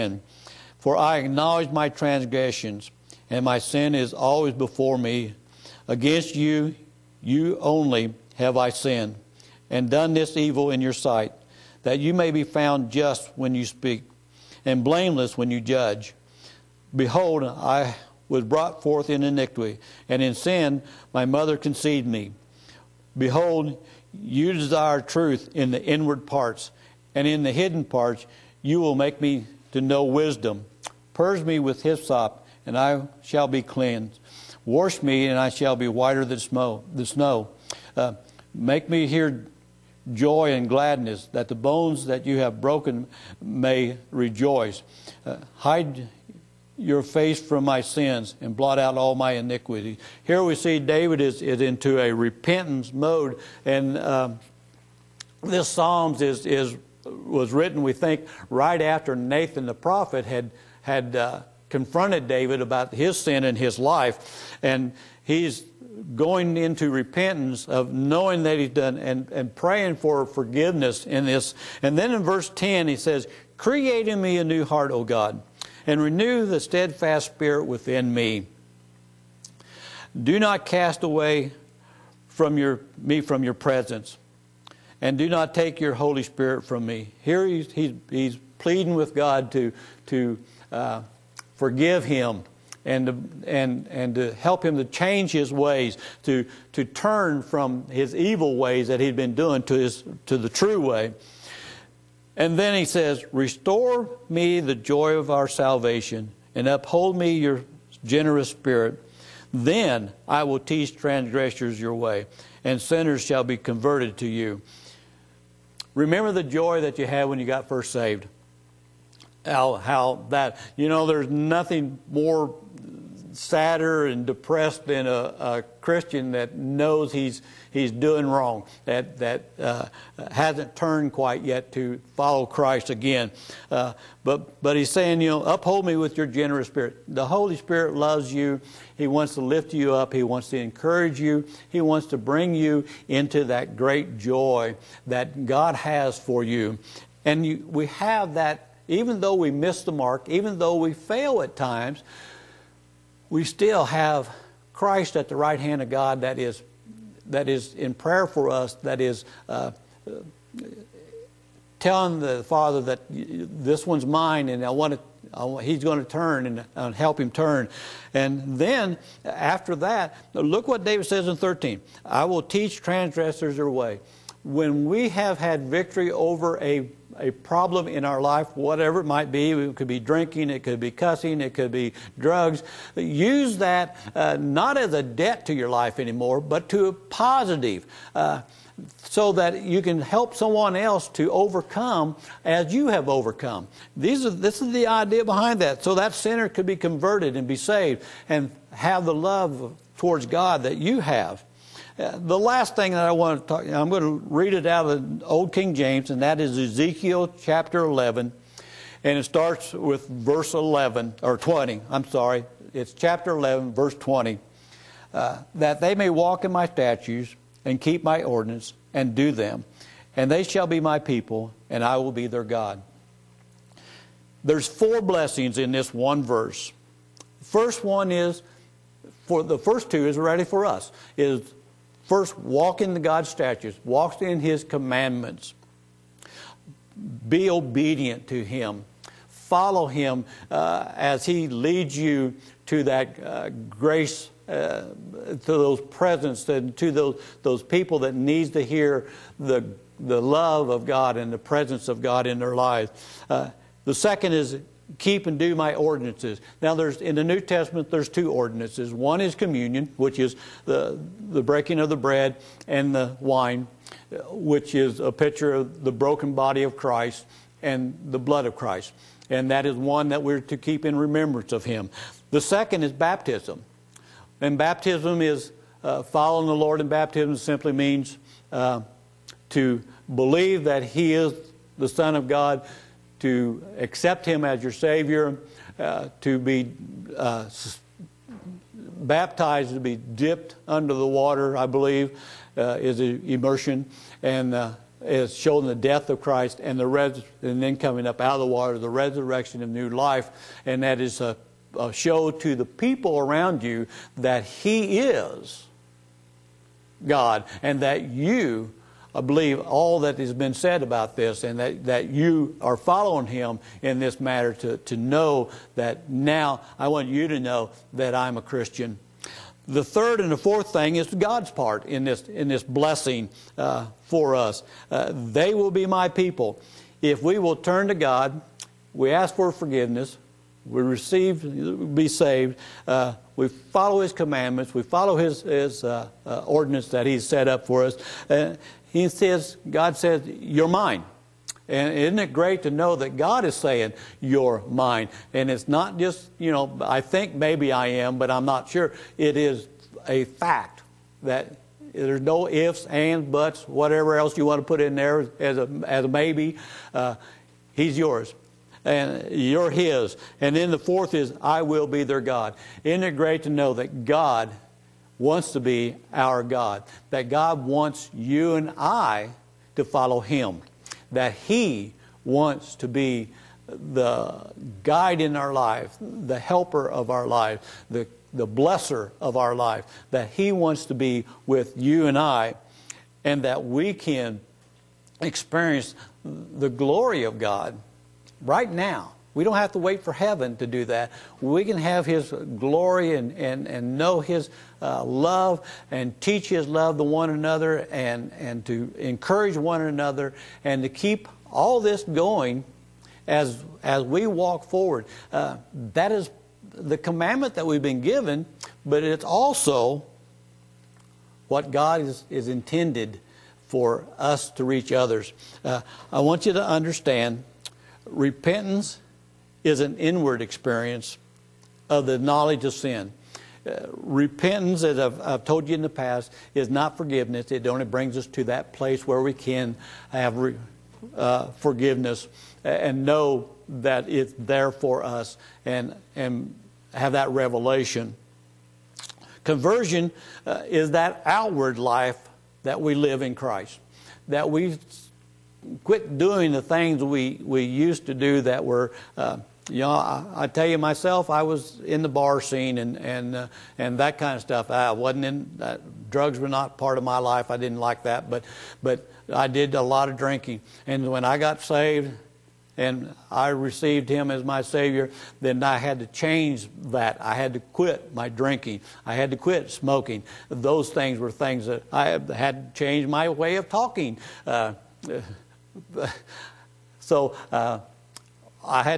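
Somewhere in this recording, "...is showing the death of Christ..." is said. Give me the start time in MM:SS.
04:55.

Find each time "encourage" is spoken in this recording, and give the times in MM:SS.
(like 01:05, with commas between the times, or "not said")
02:20, 06:38.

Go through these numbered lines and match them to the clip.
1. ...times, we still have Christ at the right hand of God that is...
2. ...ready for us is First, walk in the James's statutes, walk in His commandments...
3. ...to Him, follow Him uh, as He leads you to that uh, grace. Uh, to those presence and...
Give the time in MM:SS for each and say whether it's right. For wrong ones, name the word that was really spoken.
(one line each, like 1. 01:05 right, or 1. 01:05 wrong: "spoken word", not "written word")
1. 02:31 right
2. 03:50 wrong: "God", not "James"
3. 03:58 right.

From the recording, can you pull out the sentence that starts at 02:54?
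When we have had victory over a a problem in our life, whatever it might be.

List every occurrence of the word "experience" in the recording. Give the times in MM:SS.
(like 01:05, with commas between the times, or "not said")
06:25, 07:00.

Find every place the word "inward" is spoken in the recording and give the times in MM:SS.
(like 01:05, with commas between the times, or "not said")
00:25, 06:59.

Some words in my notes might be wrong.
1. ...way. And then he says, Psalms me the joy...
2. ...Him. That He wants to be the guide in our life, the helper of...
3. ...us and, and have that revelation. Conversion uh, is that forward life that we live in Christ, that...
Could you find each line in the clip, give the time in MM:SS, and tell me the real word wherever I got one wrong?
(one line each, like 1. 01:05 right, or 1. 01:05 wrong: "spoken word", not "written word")
1. 01:40 wrong: "Restore", not "Psalms"
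2. 06:10 right
3. 07:15 wrong: "outward", not "forward".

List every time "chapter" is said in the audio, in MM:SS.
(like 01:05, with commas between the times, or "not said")
03:27, 03:32.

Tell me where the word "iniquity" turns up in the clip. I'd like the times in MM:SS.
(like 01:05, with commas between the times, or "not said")
00:19, 00:49.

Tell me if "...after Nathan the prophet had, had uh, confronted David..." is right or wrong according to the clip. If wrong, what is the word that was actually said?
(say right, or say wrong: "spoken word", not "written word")
right.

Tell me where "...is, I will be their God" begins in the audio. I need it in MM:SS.
06:01.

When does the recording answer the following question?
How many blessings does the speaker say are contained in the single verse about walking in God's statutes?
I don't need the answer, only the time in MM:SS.
03:44.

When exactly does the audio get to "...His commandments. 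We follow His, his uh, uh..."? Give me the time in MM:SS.
05:34.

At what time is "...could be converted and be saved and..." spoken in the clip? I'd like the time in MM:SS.
03:16.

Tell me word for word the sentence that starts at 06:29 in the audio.
We don't have to wait for heaven to do that.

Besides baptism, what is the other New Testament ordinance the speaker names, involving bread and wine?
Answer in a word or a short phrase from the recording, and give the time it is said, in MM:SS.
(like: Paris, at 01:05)
Communion, at 04:19.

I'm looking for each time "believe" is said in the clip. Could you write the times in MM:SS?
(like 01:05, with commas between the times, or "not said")
04:40, 04:51, 05:09.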